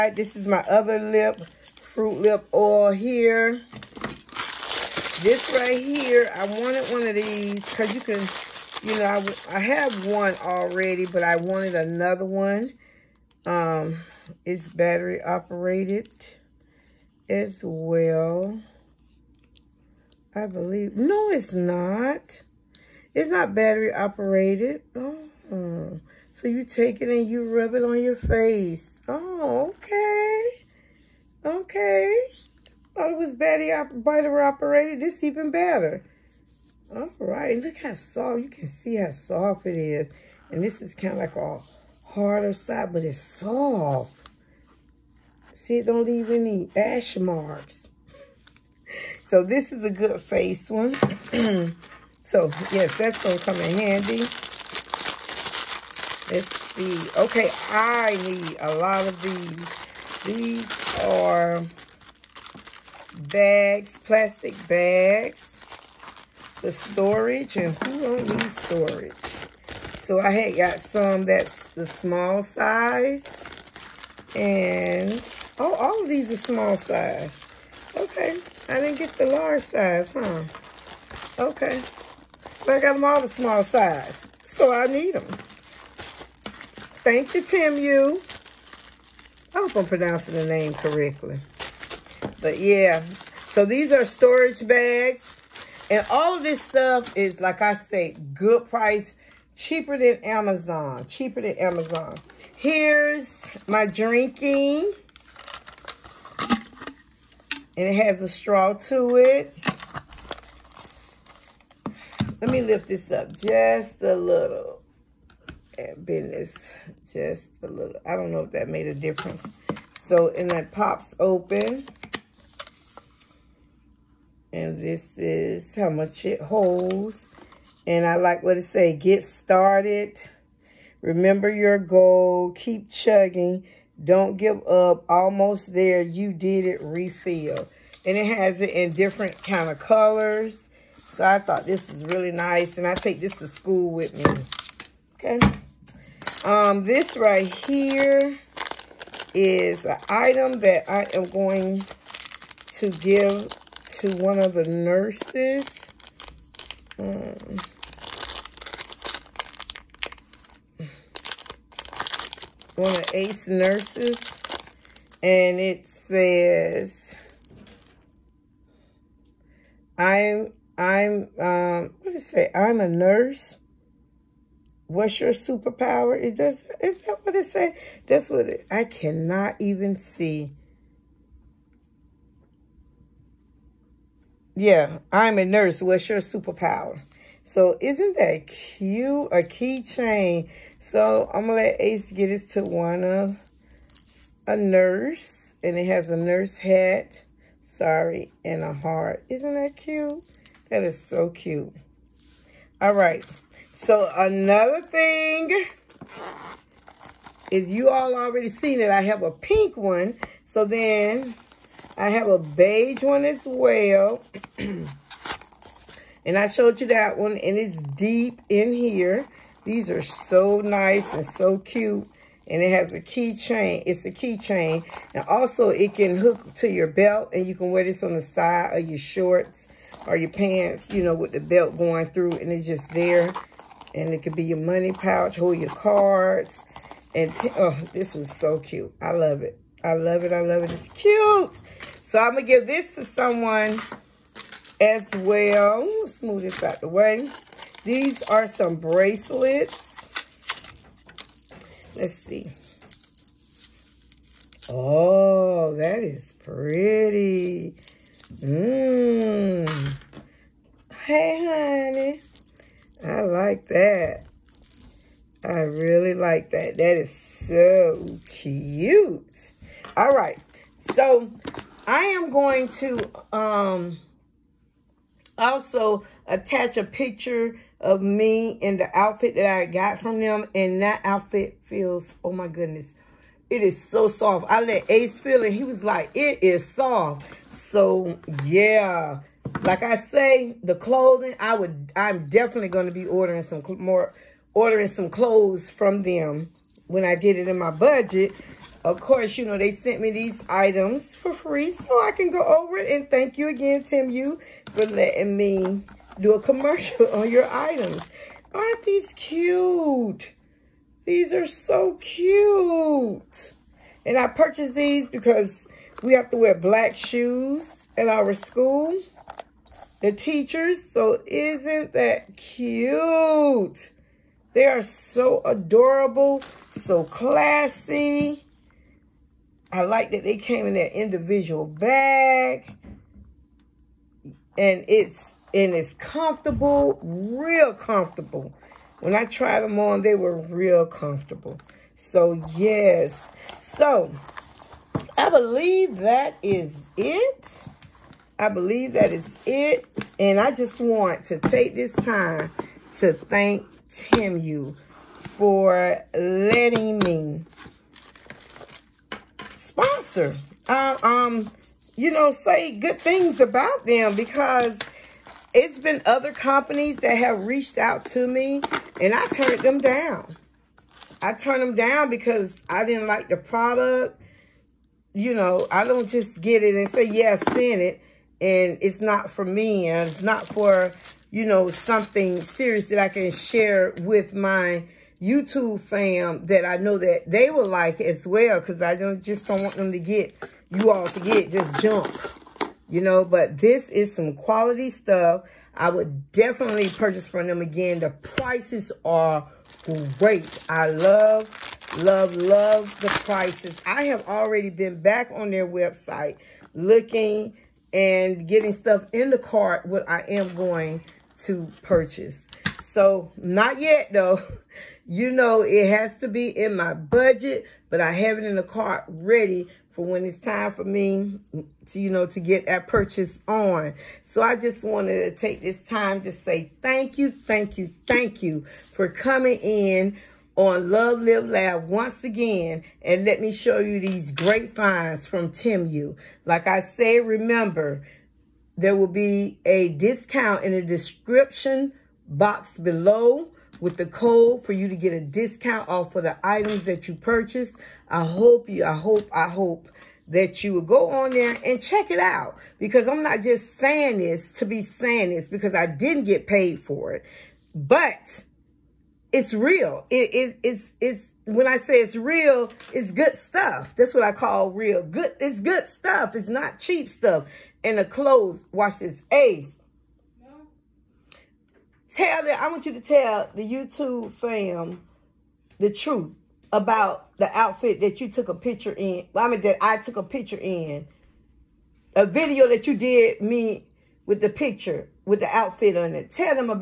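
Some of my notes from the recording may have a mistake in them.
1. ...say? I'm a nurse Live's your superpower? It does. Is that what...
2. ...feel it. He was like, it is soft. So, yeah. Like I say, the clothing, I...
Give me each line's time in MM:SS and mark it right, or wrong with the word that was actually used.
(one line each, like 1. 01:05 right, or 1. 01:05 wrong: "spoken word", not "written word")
1. 02:52 wrong: "What", not "Live"
2. 04:45 right.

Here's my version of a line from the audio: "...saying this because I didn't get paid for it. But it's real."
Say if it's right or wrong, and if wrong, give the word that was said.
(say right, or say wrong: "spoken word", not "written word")
right.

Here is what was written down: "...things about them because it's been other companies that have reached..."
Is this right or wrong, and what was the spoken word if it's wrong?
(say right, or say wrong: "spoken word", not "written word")
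right.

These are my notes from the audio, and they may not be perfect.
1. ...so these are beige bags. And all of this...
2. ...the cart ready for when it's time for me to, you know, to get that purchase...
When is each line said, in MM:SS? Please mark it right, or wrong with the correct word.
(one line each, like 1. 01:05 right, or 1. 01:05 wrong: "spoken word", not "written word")
1. 01:33 wrong: "storage", not "beige"
2. 06:58 right.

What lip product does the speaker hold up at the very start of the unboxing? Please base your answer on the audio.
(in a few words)
Fruit Lip Oil.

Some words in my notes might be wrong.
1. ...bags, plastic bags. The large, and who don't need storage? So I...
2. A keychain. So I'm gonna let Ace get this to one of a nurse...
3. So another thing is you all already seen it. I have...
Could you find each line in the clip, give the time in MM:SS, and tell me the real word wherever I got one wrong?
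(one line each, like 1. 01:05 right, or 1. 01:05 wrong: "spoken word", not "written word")
1. 01:03 wrong: "storage", not "large"
2. 03:09 right
3. 03:23 right.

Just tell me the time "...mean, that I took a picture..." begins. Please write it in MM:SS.
07:59.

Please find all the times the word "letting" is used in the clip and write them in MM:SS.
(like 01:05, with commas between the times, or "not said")
05:04, 05:56.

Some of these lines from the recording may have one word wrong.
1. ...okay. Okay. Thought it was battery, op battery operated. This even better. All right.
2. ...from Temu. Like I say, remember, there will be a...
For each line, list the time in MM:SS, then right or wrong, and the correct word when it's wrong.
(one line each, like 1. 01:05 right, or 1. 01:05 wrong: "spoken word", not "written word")
1. 00:29 right
2. 07:15 right.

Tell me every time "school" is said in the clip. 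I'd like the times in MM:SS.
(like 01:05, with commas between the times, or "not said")
02:23, 05:18.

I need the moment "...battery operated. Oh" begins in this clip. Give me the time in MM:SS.
00:23.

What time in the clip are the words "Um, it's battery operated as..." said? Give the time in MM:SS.
00:13.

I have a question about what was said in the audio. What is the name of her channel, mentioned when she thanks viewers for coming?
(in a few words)
Love Live Laugh.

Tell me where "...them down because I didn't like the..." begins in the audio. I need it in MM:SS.
06:11.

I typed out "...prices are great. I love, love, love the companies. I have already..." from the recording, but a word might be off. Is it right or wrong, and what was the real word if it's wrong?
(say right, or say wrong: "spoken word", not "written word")
wrong: "prices", not "companies".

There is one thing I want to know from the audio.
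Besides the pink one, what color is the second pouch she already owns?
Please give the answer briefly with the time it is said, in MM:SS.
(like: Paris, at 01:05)
Beige, at 03:32.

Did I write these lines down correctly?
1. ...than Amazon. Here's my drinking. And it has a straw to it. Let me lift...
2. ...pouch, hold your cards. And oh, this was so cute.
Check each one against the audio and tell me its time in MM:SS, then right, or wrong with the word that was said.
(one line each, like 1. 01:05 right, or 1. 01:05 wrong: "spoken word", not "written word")
1. 01:41 right
2. 03:54 right.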